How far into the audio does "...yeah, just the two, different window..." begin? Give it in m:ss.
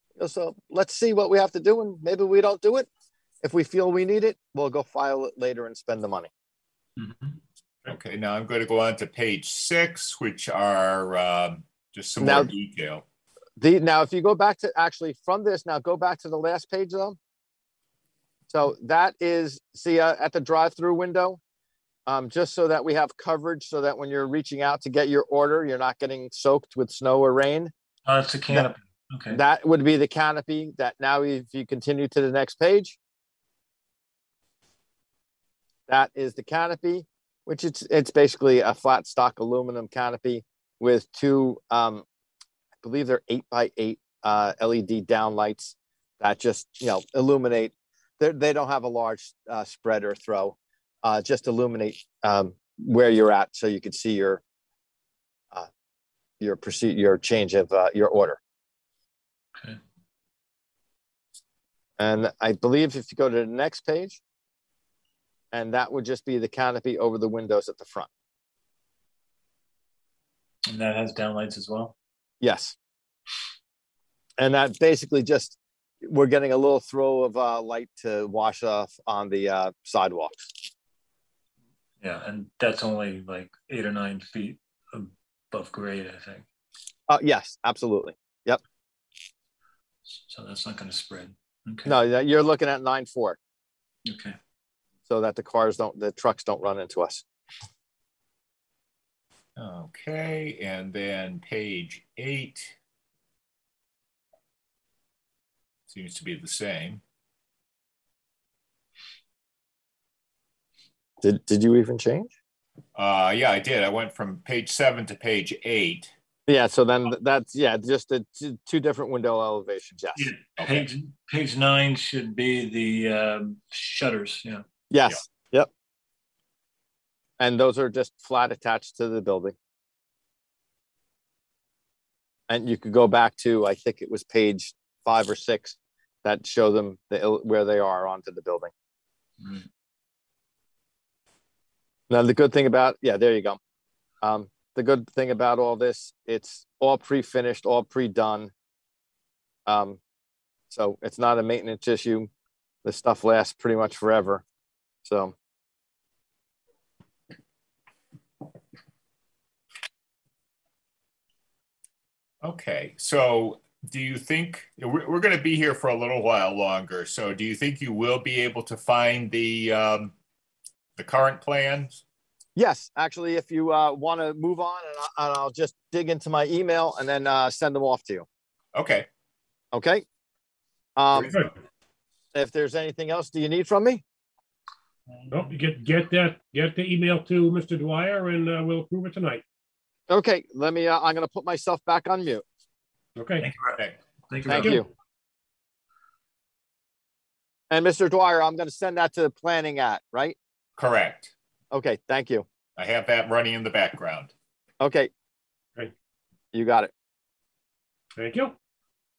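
1:57.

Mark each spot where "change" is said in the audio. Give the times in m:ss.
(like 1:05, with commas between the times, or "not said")
0:57, 1:51.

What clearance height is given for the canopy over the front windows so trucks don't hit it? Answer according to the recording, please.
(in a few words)
9'4".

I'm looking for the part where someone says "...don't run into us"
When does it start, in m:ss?
1:36.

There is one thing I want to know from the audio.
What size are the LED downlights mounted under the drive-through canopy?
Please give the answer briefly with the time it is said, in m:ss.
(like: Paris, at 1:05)
8 by 8, at 0:43.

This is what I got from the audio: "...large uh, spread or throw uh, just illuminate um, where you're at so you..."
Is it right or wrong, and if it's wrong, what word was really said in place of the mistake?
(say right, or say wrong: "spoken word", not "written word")
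right.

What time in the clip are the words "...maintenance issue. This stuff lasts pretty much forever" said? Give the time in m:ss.
2:31.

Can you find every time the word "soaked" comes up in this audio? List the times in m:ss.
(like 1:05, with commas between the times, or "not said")
0:26.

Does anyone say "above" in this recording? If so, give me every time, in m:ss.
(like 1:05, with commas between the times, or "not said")
1:25.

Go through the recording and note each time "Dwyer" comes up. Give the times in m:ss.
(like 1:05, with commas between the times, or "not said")
3:07, 3:18.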